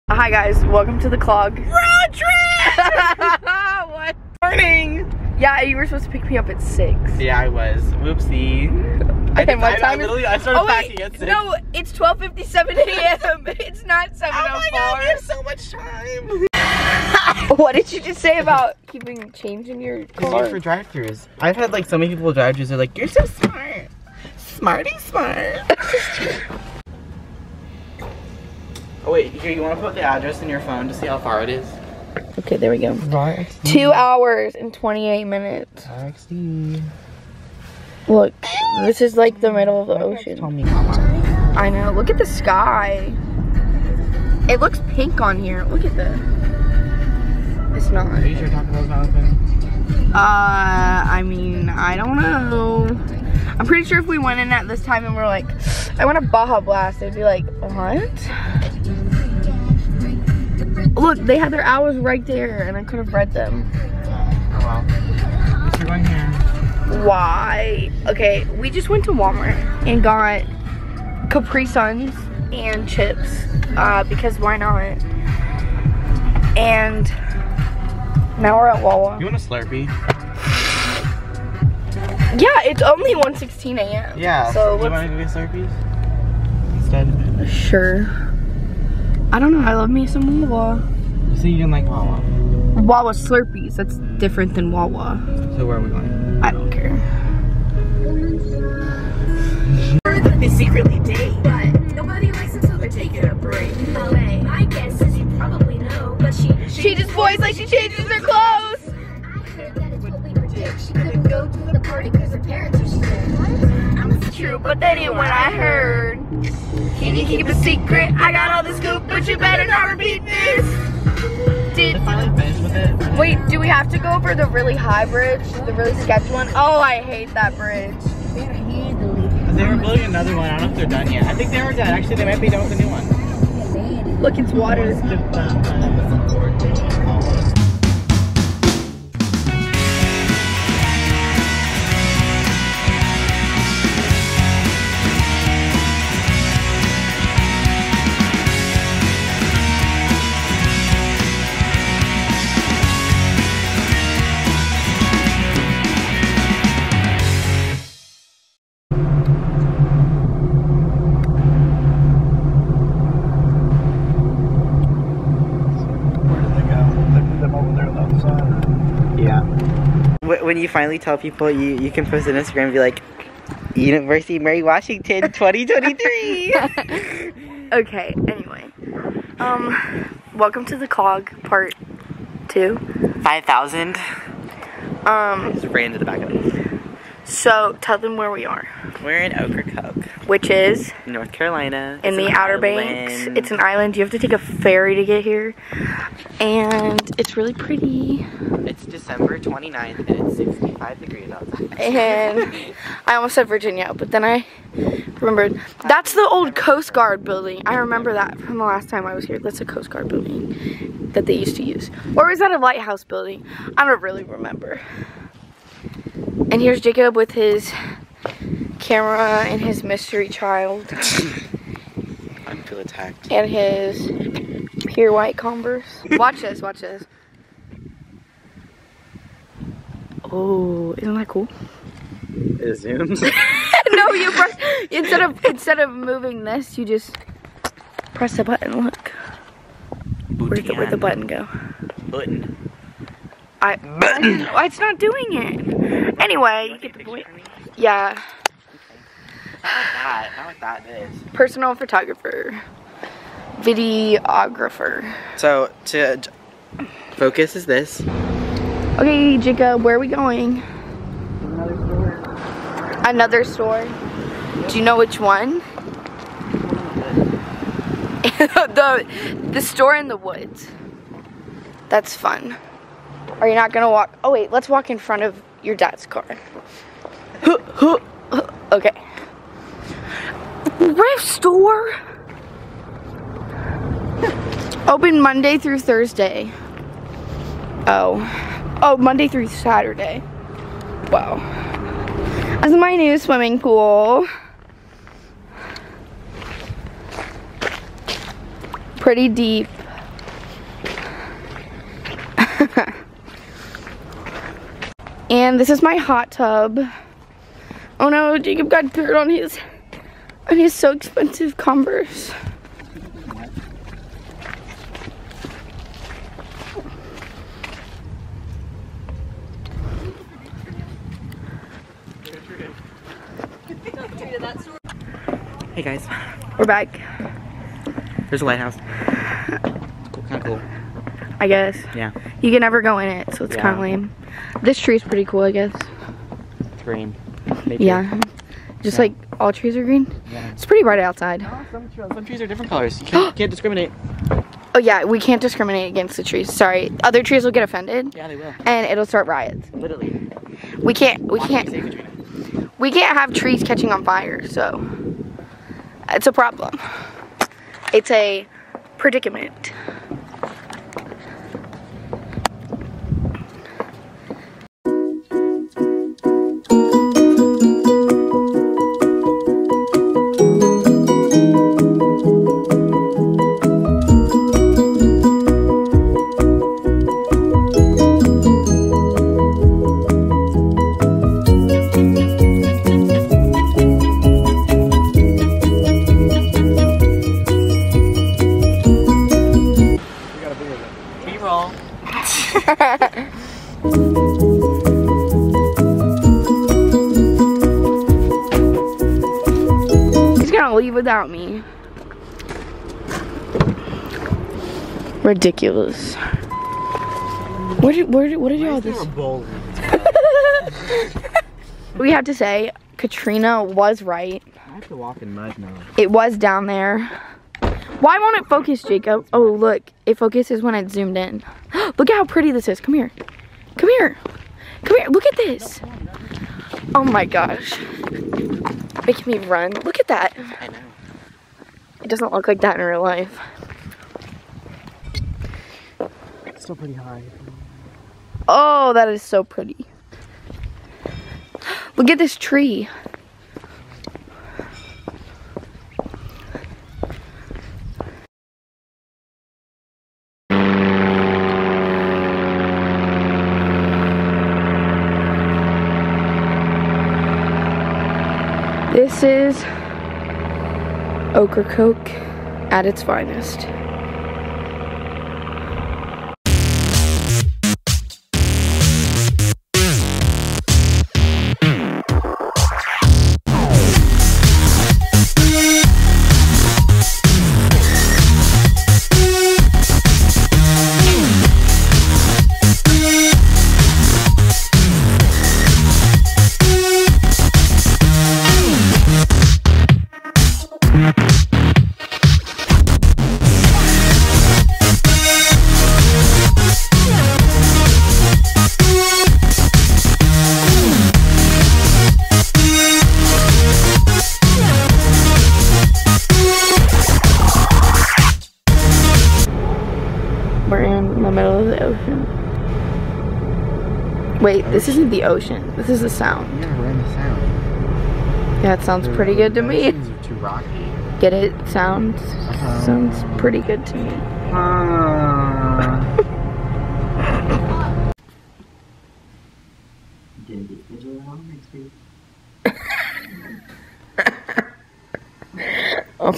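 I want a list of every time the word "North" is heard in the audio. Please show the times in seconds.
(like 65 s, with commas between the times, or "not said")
191 s.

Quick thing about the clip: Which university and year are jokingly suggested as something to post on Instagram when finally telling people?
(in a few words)
University of Mary Washington 2023.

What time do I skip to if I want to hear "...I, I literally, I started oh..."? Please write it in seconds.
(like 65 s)
9 s.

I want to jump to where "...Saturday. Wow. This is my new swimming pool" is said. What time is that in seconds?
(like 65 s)
289 s.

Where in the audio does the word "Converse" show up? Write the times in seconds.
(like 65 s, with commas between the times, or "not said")
225 s, 311 s.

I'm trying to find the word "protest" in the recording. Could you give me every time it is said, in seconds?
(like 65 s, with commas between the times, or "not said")
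not said.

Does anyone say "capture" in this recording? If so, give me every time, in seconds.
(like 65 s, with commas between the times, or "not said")
not said.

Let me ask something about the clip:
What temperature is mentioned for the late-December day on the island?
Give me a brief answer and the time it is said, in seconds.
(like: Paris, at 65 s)
65 degrees, at 200 s.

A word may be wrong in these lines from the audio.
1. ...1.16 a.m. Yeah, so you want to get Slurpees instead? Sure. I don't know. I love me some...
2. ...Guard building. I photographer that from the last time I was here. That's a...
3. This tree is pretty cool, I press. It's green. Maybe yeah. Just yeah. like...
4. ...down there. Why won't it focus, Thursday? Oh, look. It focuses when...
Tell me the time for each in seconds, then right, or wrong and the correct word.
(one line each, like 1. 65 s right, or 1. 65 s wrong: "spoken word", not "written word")
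1. 83 s right
2. 206 s wrong: "remember", not "photographer"
3. 334 s wrong: "guess", not "press"
4. 416 s wrong: "Jacob", not "Thursday".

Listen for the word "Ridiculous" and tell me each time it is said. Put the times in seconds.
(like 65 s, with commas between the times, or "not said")
405 s.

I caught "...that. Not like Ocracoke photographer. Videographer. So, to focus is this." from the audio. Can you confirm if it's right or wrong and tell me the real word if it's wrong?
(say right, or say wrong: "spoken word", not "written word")
wrong: "Personal", not "Ocracoke".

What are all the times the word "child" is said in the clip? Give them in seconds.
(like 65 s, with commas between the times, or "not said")
220 s.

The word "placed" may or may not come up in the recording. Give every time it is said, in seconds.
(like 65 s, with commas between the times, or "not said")
not said.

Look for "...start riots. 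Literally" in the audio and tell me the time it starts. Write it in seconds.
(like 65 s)
349 s.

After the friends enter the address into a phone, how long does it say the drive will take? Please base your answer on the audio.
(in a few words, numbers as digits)
2 hours and 28 minutes.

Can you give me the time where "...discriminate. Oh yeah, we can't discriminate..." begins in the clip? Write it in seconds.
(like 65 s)
343 s.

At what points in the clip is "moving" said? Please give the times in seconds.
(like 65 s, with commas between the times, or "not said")
235 s.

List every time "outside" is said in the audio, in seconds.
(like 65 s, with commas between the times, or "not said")
201 s, 340 s.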